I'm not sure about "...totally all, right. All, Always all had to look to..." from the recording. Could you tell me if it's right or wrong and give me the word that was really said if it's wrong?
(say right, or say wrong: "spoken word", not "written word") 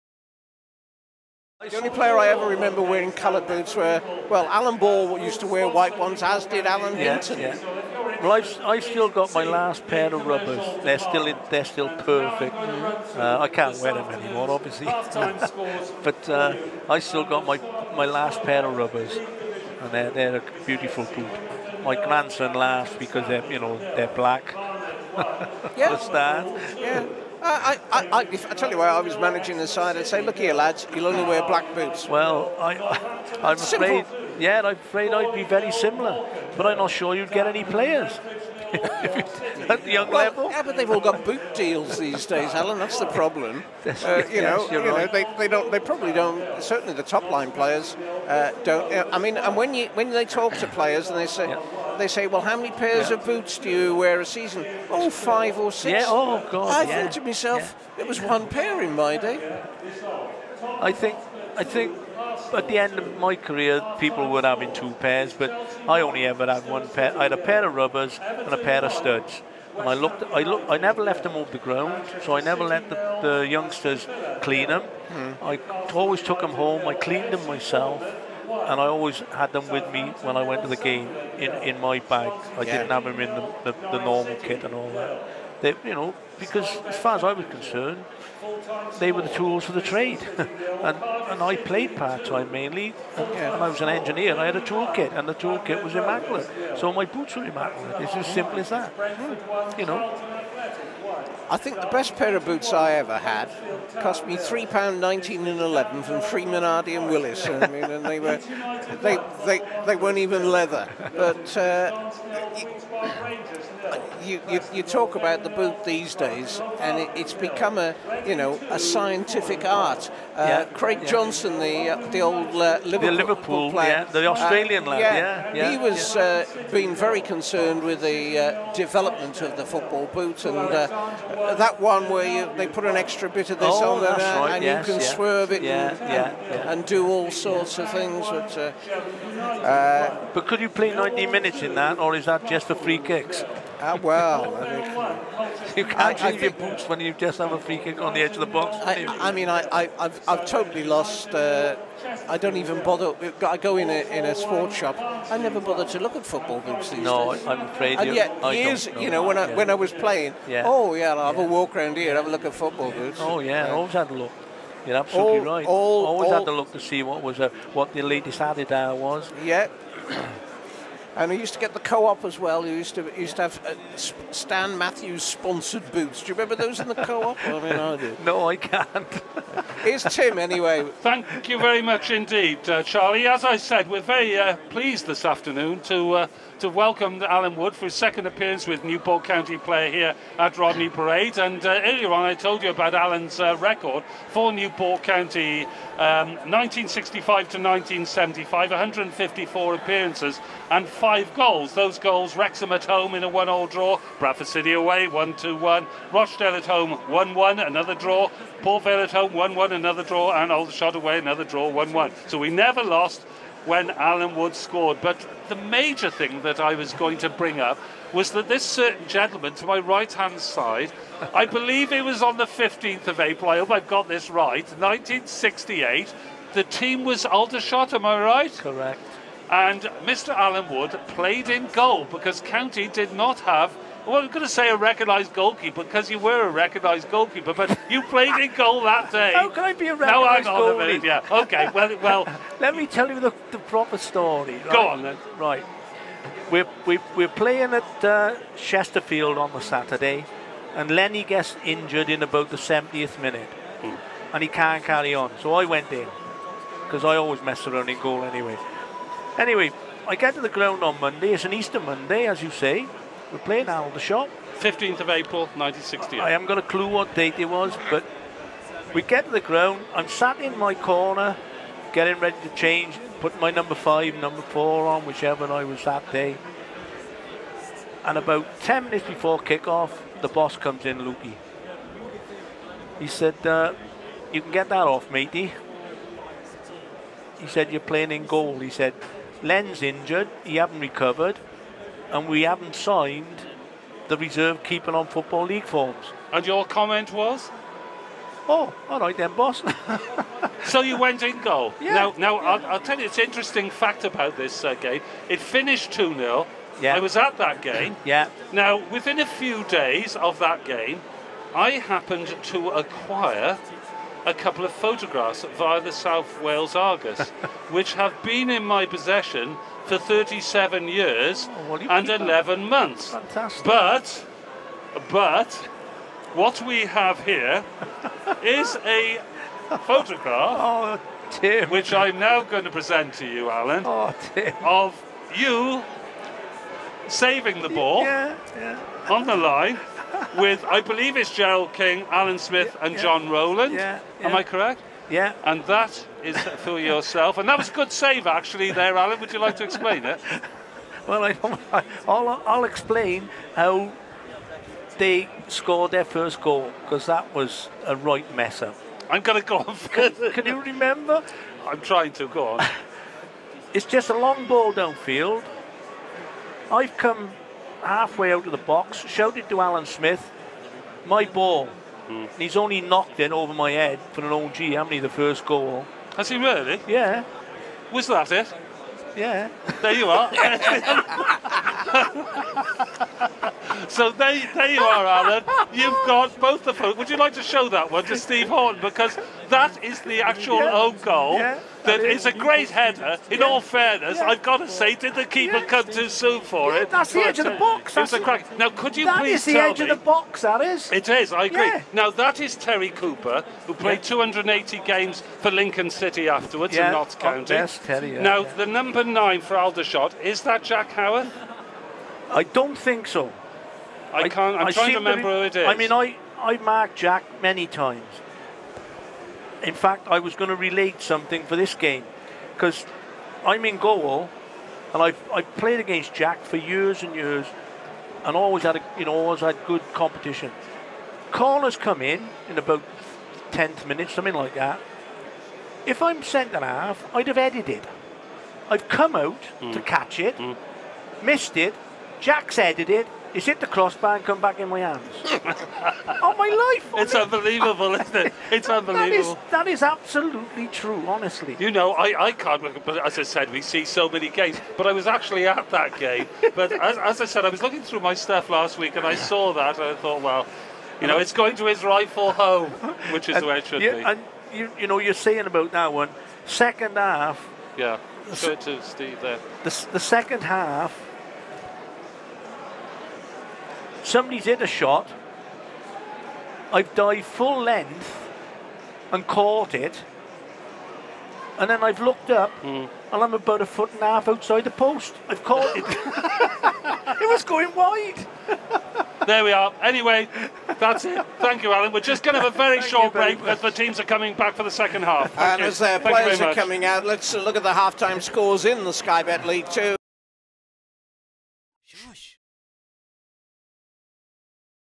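wrong: "absolutely", not "totally".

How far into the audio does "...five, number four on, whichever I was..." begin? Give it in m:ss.
4:33.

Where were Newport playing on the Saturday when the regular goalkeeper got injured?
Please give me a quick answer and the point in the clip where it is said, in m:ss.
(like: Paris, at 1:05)
Chesterfield, at 4:08.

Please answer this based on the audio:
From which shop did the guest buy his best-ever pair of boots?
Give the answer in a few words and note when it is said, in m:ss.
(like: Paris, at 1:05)
Freeman Hardy and Willis, at 1:46.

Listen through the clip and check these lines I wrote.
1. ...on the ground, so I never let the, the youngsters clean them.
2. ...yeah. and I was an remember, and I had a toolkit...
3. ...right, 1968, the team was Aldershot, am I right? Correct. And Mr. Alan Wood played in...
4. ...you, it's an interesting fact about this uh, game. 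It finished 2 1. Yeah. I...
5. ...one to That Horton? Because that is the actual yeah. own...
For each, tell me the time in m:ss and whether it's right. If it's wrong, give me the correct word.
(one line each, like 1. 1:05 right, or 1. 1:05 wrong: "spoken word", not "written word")
1. 1:11 right
2. 1:33 wrong: "engineer", not "remember"
3. 3:44 right
4. 5:02 wrong: "0", not "1"
5. 6:27 wrong: "Steve", not "That".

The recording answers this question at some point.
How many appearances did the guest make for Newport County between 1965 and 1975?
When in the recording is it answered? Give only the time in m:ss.
3:18.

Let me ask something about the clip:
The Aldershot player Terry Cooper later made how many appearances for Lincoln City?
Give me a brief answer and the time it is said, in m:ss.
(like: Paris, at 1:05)
280, at 6:44.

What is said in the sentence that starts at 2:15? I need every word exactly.
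swerve it yeah, and, yeah, and, do all sorts of things.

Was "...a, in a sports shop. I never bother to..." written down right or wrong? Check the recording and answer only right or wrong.
right.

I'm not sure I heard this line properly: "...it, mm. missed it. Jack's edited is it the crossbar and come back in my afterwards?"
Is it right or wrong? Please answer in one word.
wrong.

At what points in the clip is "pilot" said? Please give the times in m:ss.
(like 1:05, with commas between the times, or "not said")
not said.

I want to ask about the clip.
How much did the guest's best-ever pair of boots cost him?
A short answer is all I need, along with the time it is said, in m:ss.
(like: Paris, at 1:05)
£3 19s 11d, at 1:44.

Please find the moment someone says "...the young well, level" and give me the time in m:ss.
0:39.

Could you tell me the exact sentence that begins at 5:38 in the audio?
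Yeah, yeah on the line with, I believe it's Gerald King, Alan Smith, yeah, and yeah.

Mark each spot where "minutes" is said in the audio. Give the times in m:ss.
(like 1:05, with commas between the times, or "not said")
2:21, 4:13, 4:38, 7:13.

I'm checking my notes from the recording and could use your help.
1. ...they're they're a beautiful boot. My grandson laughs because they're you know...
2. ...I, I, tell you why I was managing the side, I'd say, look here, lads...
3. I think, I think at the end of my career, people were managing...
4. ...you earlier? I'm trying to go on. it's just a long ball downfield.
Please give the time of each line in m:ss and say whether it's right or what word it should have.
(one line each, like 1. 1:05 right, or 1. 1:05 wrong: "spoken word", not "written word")
1. 0:19 right
2. 0:28 right
3. 1:00 wrong: "having", not "managing"
4. 6:00 wrong: "remember", not "earlier".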